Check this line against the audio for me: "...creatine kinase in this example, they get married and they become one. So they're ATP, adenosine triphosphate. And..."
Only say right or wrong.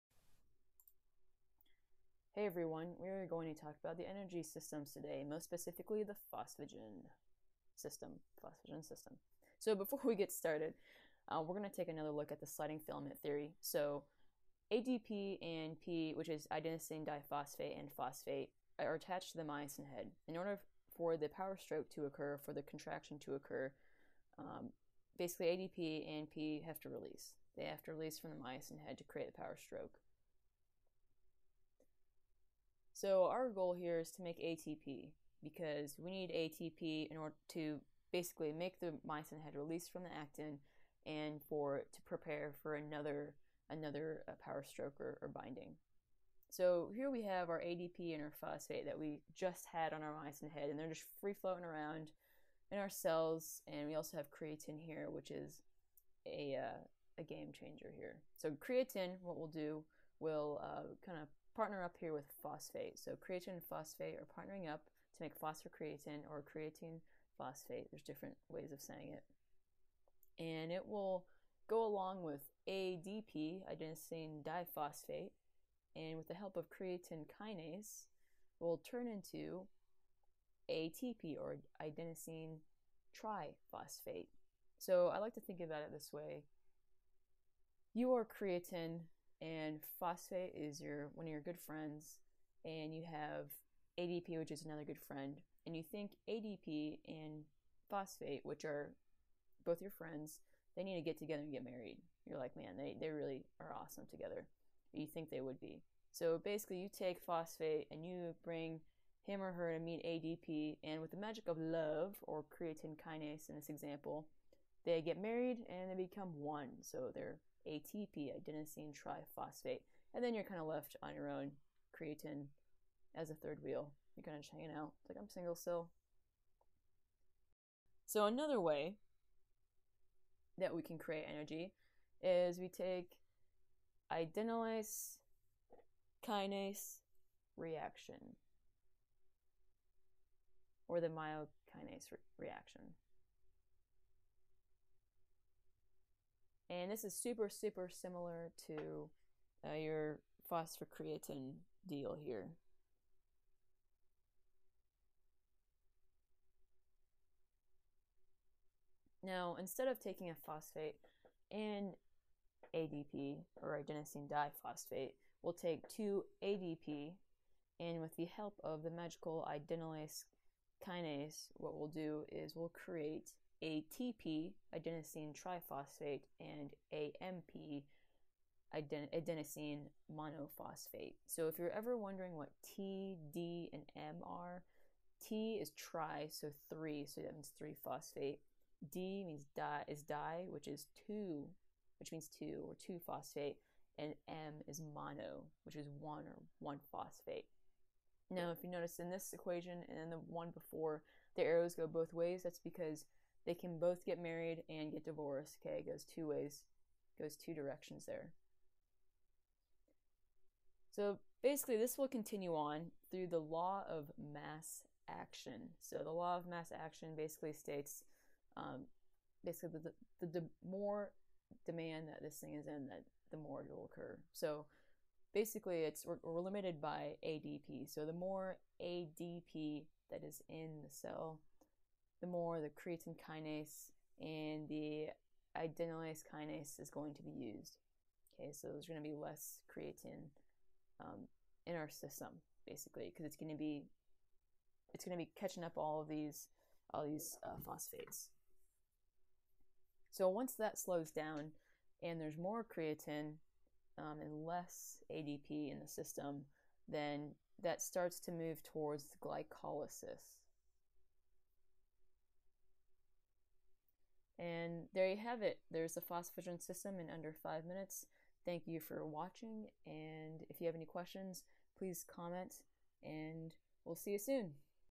right.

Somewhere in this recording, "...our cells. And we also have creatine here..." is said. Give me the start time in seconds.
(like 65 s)
52 s.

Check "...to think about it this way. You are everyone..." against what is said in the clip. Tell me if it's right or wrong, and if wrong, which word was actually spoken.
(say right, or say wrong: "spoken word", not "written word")
wrong: "creatine", not "everyone".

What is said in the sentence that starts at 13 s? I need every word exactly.
So ADP and P, which is adenosine diphosphate and phosphate, are attached to the myosin head.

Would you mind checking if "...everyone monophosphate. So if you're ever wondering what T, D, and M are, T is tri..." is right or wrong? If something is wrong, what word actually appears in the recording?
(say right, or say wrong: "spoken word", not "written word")
wrong: "adenosine", not "everyone".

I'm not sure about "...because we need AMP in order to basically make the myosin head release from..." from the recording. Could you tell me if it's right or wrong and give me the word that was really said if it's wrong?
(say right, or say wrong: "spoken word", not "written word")
wrong: "ATP", not "AMP".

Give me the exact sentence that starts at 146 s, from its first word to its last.
And this is super, super similar to uh, your phosphocreatine deal here.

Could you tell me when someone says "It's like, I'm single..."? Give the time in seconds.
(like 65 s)
125 s.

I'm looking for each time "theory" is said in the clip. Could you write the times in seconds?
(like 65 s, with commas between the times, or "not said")
13 s.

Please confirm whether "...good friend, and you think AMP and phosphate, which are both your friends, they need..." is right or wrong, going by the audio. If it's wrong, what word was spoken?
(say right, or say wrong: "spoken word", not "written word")
wrong: "ADP", not "AMP".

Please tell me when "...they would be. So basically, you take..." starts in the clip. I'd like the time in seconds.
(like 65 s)
105 s.